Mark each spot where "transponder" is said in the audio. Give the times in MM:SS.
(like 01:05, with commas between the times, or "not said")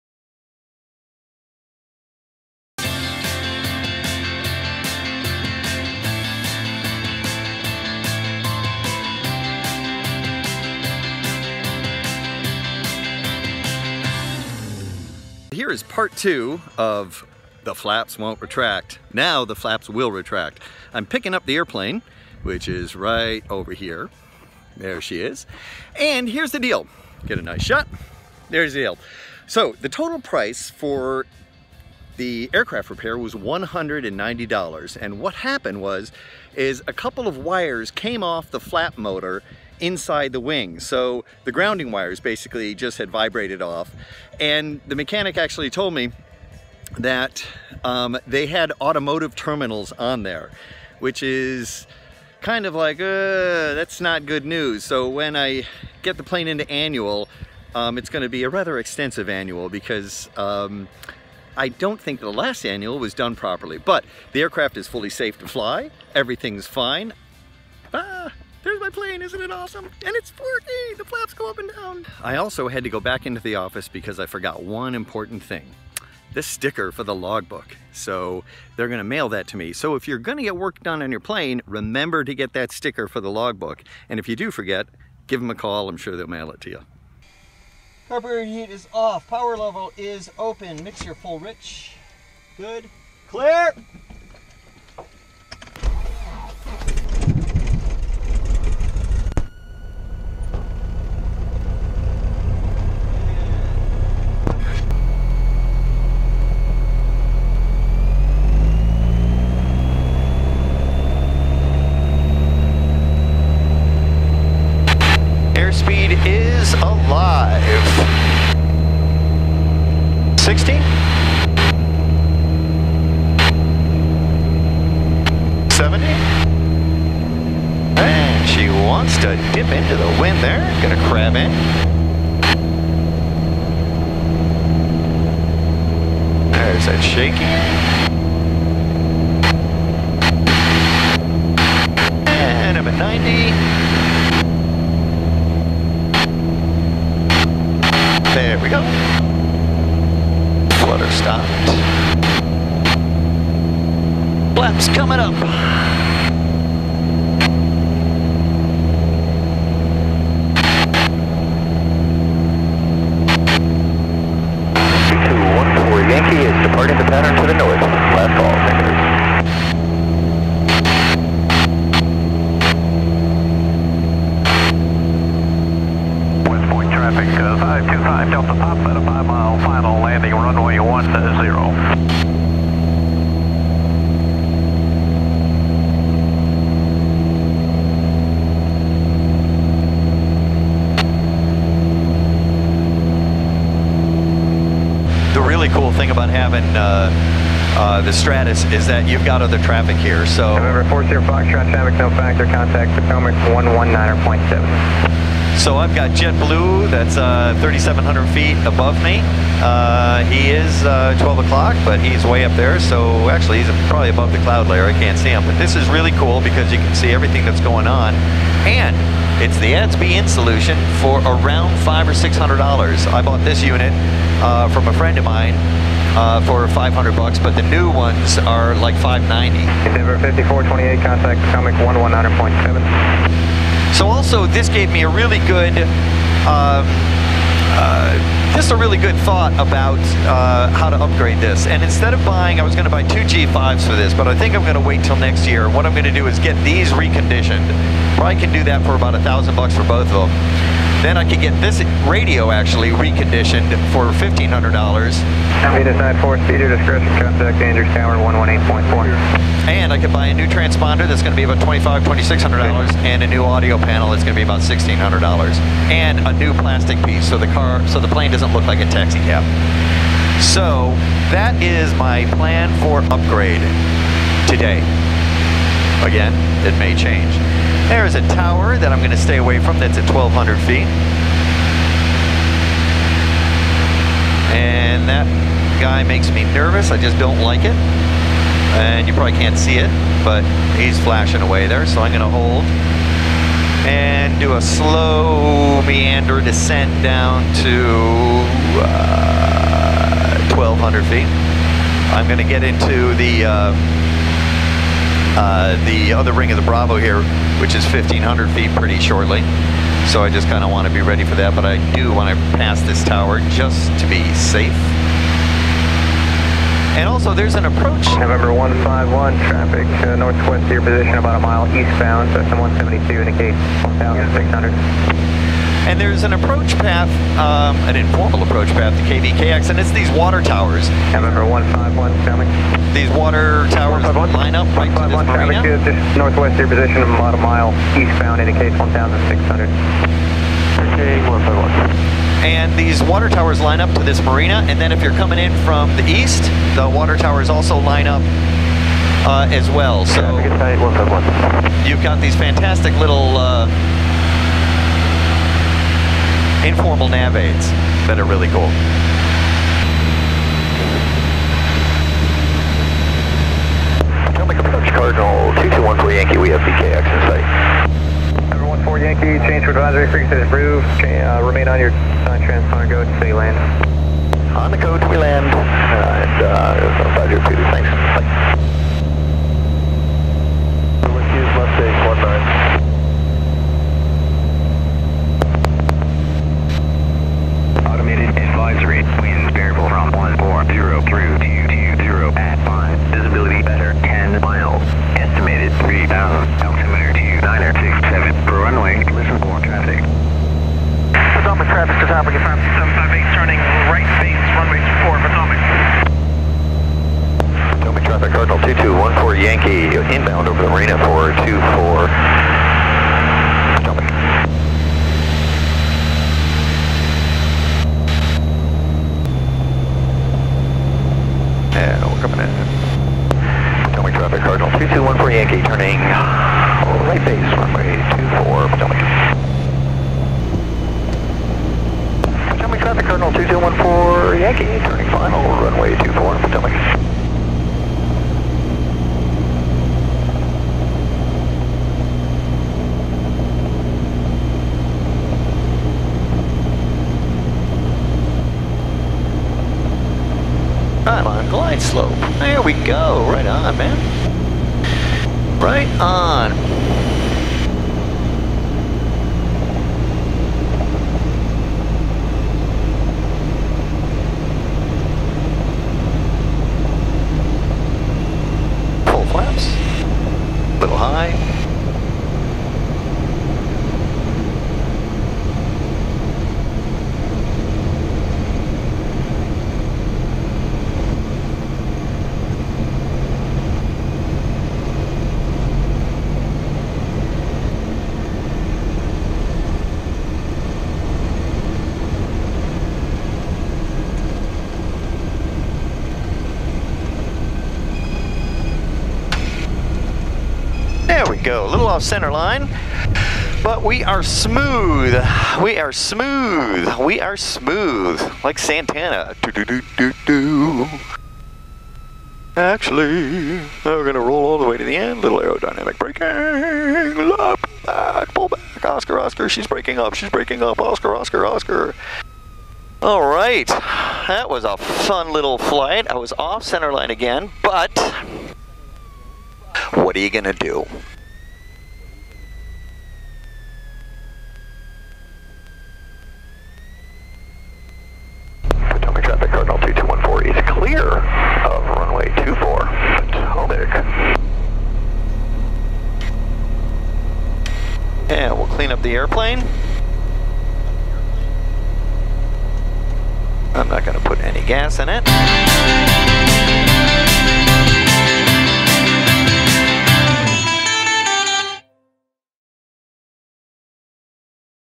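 04:20, 06:12.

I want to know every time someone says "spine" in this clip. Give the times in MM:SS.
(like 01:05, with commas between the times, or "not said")
not said.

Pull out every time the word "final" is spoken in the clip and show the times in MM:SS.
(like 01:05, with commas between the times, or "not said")
02:59, 07:15.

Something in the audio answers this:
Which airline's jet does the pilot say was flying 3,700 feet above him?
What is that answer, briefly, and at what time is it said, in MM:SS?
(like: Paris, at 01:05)
JetBlue, at 03:26.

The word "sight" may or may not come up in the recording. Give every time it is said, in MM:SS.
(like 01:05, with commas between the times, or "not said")
06:07.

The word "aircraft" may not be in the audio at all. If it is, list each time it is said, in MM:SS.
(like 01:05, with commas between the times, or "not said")
00:32, 01:04.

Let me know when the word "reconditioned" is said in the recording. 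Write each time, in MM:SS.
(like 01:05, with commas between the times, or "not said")
04:06, 04:12.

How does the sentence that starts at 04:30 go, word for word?
So that is my plan for upgrade today.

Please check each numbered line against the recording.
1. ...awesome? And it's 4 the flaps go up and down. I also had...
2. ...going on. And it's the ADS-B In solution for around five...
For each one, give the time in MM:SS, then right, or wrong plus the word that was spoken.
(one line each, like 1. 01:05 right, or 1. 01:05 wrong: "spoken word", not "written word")
1. 01:09 right
2. 03:37 right.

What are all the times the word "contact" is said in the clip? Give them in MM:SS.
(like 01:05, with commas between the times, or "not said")
03:22, 03:51, 04:17.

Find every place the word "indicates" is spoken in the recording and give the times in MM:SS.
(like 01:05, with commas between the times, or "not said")
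05:23, 05:38.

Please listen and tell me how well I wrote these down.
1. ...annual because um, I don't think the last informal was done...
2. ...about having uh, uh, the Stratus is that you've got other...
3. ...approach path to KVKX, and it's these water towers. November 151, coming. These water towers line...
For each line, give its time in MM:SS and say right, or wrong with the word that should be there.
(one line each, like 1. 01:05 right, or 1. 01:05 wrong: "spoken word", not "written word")
1. 00:59 wrong: "annual", not "informal"
2. 03:16 right
3. 05:28 right.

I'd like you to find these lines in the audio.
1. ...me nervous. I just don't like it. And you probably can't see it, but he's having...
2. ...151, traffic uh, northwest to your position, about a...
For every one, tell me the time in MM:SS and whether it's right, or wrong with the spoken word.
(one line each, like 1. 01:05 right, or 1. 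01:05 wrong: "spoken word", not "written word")
1. 04:46 wrong: "flashing", not "having"
2. 05:18 right.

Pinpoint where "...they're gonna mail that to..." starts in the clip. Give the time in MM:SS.
01:18.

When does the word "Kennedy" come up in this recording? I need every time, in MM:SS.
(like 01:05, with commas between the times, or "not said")
not said.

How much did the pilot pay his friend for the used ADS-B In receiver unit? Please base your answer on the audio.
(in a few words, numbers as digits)
$500.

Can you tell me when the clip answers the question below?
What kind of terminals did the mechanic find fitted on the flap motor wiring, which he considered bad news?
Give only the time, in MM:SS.
00:48.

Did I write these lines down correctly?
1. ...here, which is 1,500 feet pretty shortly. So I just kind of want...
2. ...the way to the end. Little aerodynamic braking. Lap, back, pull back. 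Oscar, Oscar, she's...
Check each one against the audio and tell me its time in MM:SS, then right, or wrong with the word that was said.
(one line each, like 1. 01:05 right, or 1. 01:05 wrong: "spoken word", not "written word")
1. 05:06 right
2. 08:34 right.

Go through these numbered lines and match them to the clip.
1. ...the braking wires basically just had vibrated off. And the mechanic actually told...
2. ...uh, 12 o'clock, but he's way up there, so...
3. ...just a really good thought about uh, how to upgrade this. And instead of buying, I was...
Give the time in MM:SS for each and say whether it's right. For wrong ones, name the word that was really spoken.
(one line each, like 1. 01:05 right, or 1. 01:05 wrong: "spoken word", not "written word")
1. 00:41 wrong: "grounding", not "braking"
2. 03:30 right
3. 03:58 right.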